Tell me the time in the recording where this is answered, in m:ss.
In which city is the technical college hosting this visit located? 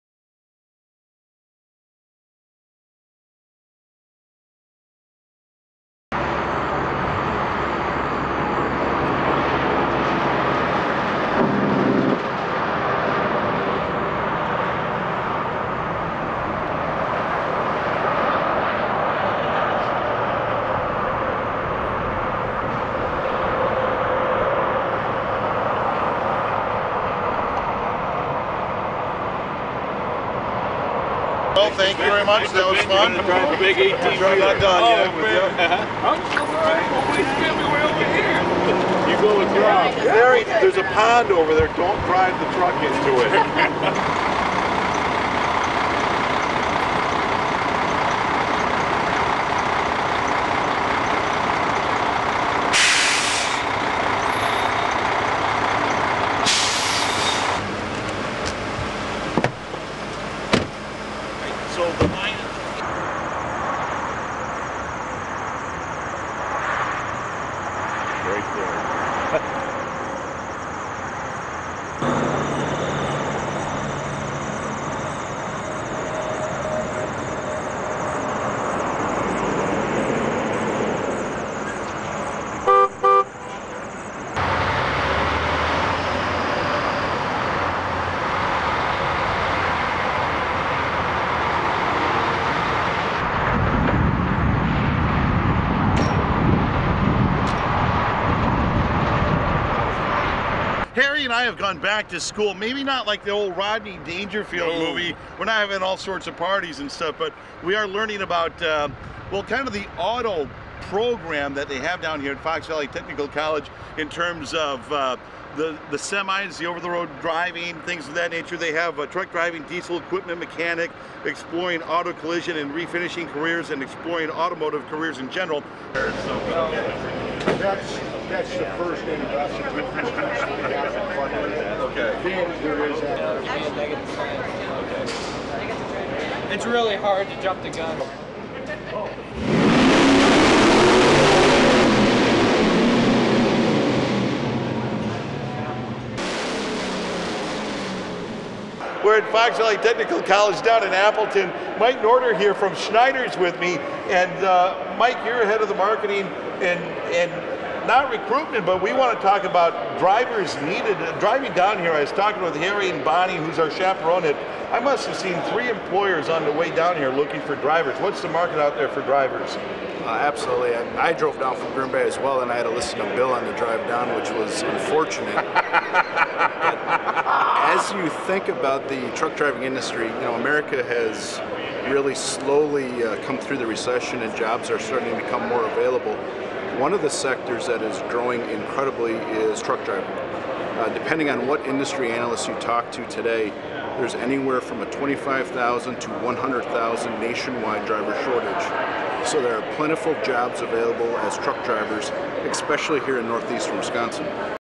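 2:30.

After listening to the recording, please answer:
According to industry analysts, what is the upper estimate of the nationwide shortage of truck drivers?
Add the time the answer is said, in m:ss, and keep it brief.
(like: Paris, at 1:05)
100,000, at 3:16.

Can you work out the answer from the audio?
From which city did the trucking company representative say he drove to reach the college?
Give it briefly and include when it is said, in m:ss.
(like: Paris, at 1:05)
Green Bay, at 2:51.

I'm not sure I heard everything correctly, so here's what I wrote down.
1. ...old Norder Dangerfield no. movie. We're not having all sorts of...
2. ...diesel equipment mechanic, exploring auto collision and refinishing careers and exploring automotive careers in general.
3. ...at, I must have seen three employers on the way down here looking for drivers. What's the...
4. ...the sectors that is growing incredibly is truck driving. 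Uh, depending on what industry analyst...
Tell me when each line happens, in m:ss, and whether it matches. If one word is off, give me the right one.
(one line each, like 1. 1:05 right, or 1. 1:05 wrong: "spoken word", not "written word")
1. 1:43 wrong: "Rodney", not "Norder"
2. 1:59 right
3. 2:44 right
4. 3:07 right.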